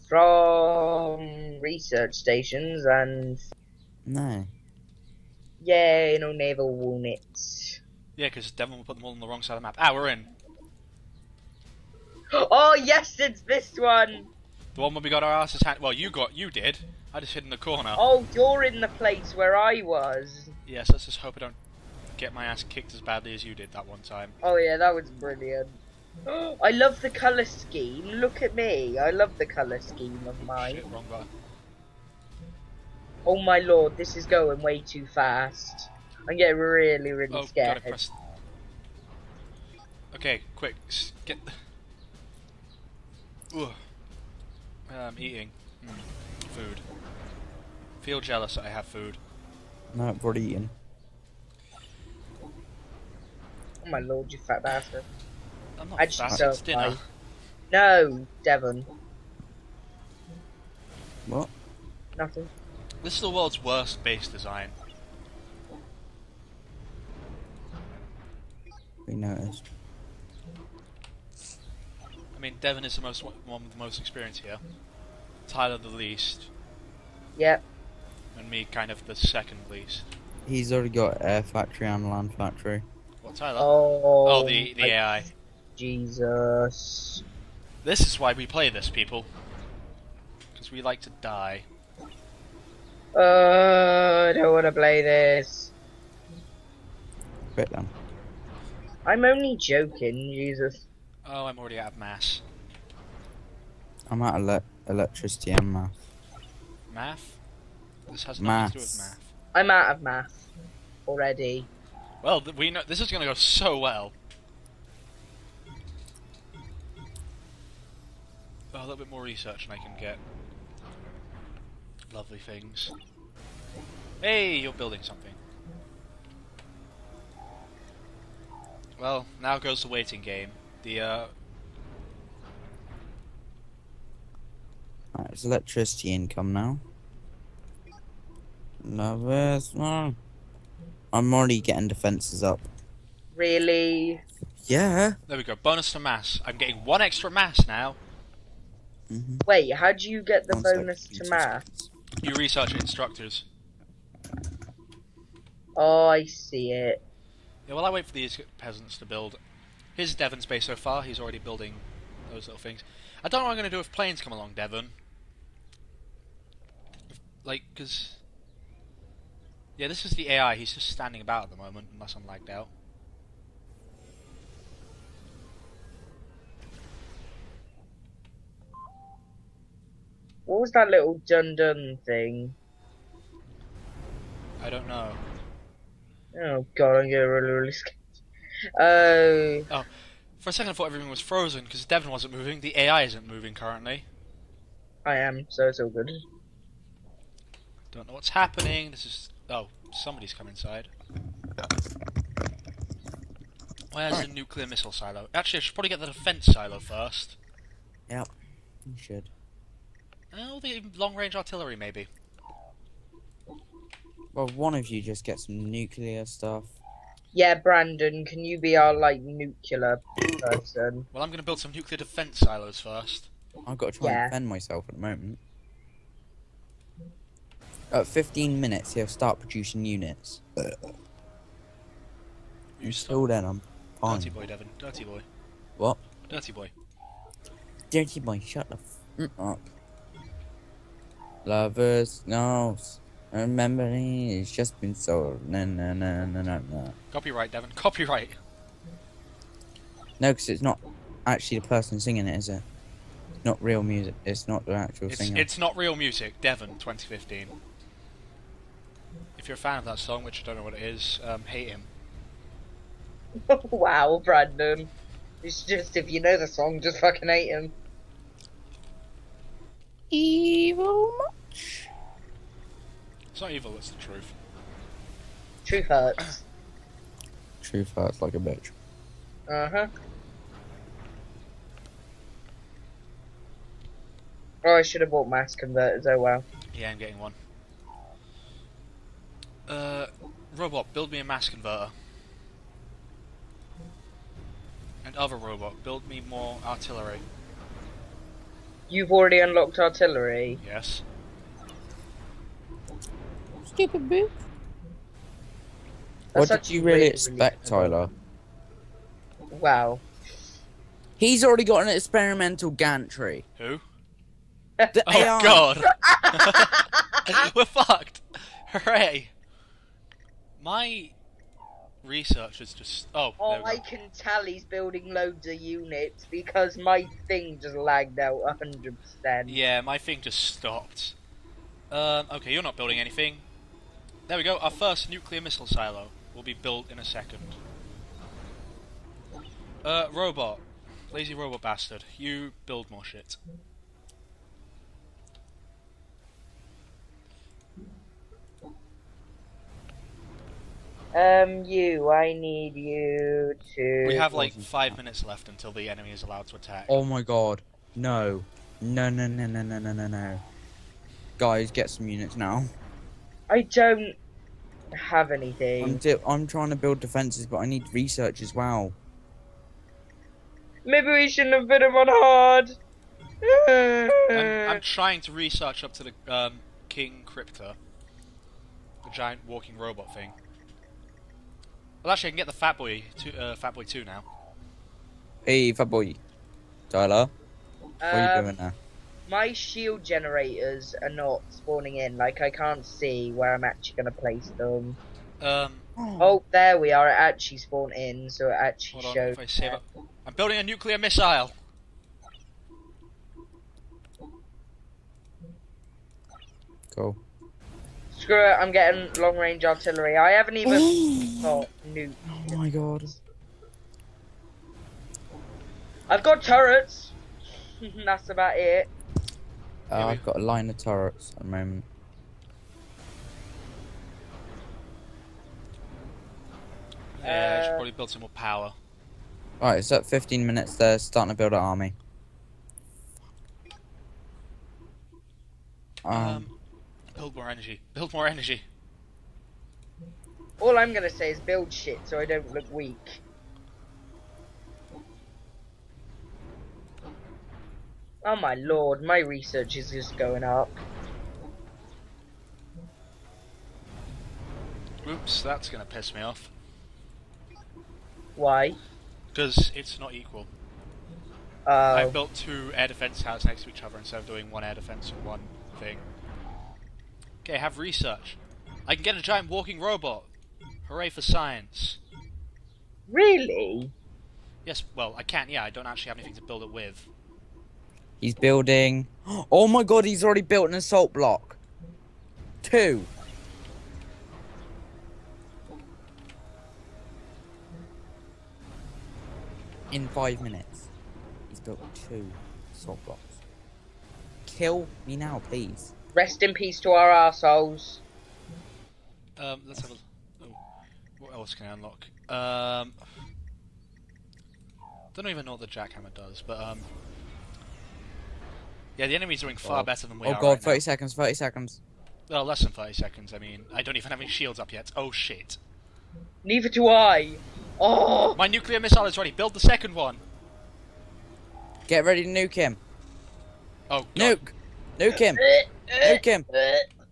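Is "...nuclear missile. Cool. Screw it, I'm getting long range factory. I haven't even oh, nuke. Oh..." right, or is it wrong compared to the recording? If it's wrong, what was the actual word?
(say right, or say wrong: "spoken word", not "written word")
wrong: "artillery", not "factory".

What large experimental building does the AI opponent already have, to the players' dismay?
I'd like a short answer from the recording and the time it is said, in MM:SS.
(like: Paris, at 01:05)
experimental gantry, at 05:11.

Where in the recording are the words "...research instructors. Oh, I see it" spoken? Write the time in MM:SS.
02:32.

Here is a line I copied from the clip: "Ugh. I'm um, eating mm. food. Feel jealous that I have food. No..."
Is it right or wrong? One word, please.
right.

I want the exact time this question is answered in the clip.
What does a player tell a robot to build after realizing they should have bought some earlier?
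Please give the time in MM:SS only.
04:51.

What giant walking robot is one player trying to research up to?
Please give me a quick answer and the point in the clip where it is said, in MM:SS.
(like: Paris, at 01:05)
King Kriptor, at 06:16.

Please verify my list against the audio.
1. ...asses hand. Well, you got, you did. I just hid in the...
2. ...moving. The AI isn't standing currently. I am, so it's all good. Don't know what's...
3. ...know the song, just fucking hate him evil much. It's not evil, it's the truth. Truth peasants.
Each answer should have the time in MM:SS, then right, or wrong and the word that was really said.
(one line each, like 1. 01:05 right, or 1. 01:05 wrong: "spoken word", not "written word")
1. 00:15 right
2. 03:12 wrong: "moving", not "standing"
3. 04:26 wrong: "hurts", not "peasants".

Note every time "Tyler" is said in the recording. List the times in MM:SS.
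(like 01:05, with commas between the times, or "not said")
01:15, 01:23, 05:07, 06:26.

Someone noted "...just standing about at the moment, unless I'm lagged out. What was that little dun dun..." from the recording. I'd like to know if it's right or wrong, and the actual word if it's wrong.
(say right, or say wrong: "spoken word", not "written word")
right.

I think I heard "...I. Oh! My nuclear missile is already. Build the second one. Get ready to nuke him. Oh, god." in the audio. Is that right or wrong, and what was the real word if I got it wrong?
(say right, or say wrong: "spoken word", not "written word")
wrong: "ready", not "already".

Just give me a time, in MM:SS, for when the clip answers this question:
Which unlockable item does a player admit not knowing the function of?
08:25.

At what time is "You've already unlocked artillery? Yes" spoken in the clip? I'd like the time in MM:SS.
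04:58.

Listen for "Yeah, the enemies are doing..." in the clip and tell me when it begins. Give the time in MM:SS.
08:28.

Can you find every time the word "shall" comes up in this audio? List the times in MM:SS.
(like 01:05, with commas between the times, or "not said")
not said.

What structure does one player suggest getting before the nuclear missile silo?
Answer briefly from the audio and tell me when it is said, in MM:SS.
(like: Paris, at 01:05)
defense silo, at 03:26.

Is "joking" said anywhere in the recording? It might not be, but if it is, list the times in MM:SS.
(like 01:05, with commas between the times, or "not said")
01:39.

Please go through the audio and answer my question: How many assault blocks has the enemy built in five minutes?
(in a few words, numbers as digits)
2.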